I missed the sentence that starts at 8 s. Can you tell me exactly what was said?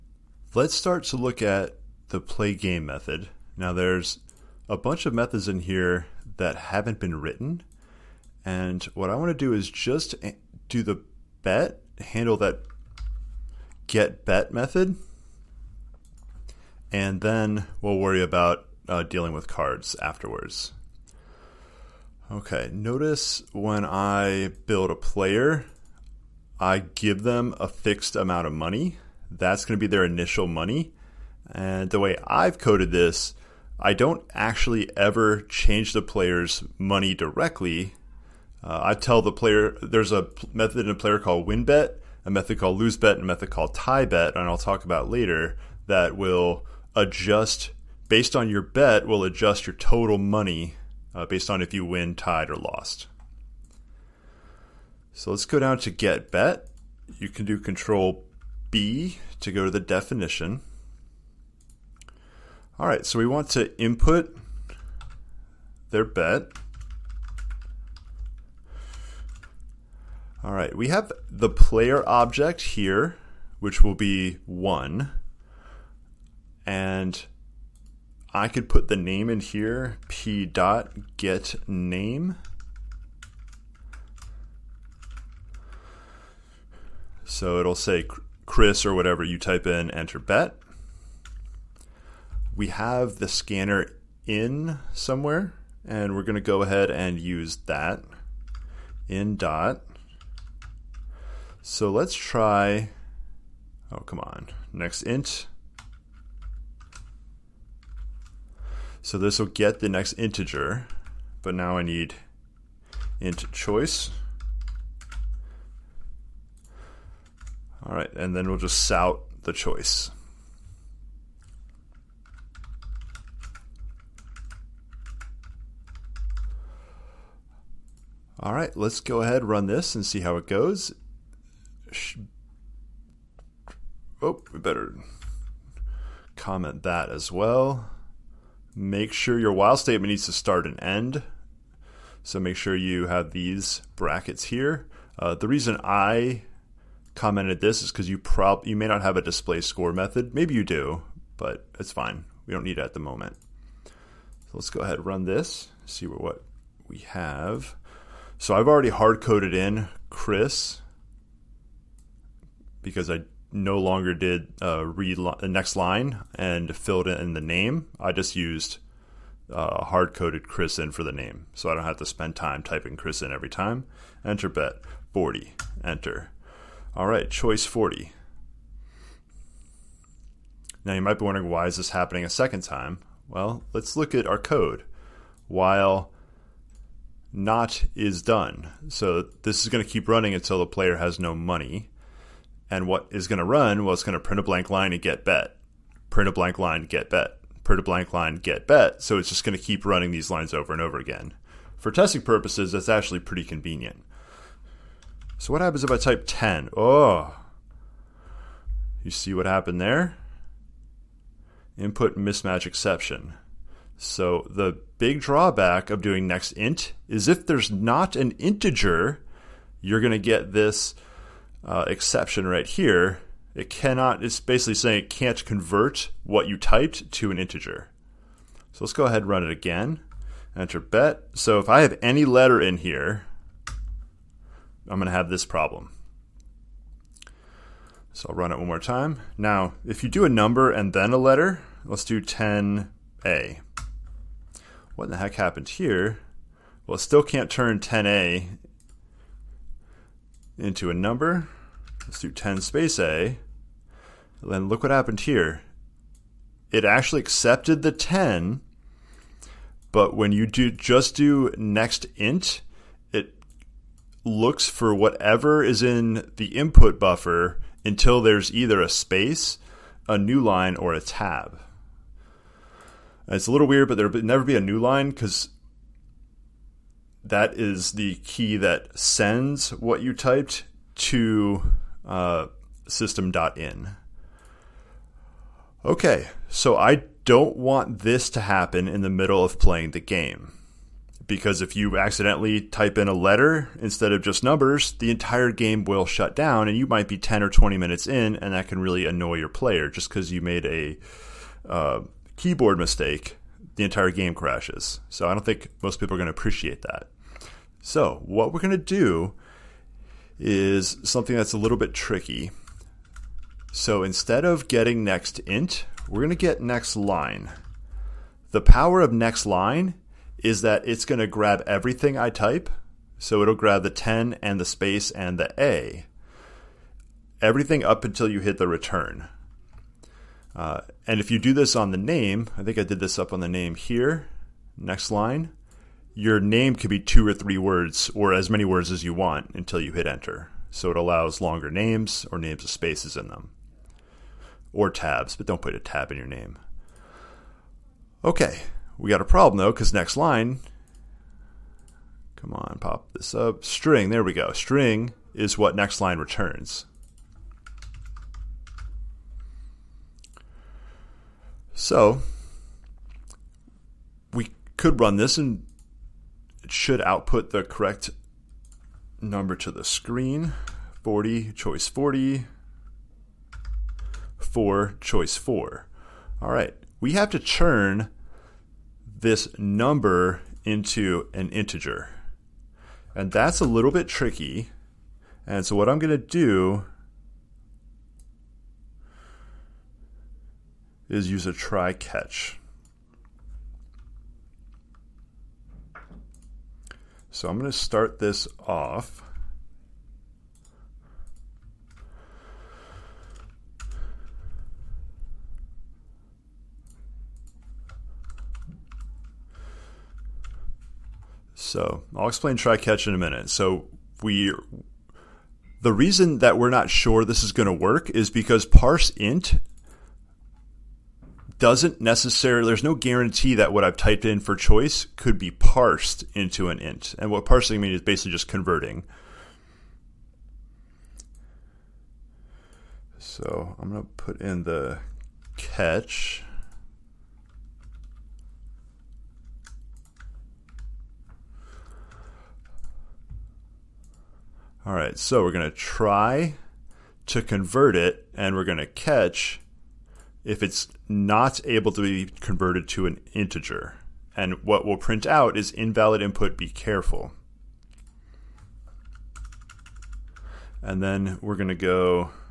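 And what I want to do is just eh, do the bet, handle that get bet method.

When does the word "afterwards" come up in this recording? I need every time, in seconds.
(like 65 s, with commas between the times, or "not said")
20 s.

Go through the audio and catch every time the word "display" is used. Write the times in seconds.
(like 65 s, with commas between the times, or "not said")
149 s.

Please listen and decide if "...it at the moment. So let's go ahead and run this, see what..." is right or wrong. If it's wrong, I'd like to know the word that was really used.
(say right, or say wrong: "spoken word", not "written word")
right.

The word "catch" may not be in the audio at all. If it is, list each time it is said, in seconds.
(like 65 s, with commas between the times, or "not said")
391 s, 412 s, 435 s, 448 s.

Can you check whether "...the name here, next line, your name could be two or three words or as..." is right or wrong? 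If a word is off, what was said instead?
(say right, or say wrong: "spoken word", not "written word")
right.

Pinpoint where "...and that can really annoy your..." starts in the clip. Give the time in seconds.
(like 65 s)
298 s.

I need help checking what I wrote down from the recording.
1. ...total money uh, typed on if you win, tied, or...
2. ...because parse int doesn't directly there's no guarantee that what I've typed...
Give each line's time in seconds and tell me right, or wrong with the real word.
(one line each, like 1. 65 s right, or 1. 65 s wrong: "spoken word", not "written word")
1. 49 s wrong: "based", not "typed"
2. 418 s wrong: "necessarily", not "directly".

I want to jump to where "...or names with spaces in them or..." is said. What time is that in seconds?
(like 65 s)
342 s.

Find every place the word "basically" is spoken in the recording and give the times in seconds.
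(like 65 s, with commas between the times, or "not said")
224 s, 428 s.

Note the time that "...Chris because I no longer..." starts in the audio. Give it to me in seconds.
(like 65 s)
160 s.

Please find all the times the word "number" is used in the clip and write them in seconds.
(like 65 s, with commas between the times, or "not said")
240 s, 250 s, 294 s, 369 s, 379 s.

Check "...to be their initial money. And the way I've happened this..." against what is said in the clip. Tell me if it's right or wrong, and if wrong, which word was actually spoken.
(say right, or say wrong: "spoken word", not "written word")
wrong: "coded", not "happened".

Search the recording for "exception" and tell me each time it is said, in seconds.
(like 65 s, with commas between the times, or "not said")
212 s, 221 s.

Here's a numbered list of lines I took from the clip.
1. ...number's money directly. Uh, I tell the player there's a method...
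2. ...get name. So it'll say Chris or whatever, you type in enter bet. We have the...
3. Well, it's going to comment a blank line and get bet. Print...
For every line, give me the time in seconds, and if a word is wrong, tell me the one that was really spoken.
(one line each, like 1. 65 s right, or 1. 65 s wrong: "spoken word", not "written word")
1. 36 s wrong: "player", not "number"
2. 81 s right
3. 193 s wrong: "print", not "comment".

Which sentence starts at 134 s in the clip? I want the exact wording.
Oh, we better comment that as well.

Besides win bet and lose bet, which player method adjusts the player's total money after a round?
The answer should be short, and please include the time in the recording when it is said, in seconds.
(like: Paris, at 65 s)
tie bet, at 43 s.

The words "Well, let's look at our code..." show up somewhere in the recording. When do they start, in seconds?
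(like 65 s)
183 s.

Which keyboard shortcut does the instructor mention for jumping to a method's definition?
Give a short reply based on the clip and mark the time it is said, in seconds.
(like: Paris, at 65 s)
control B, at 57 s.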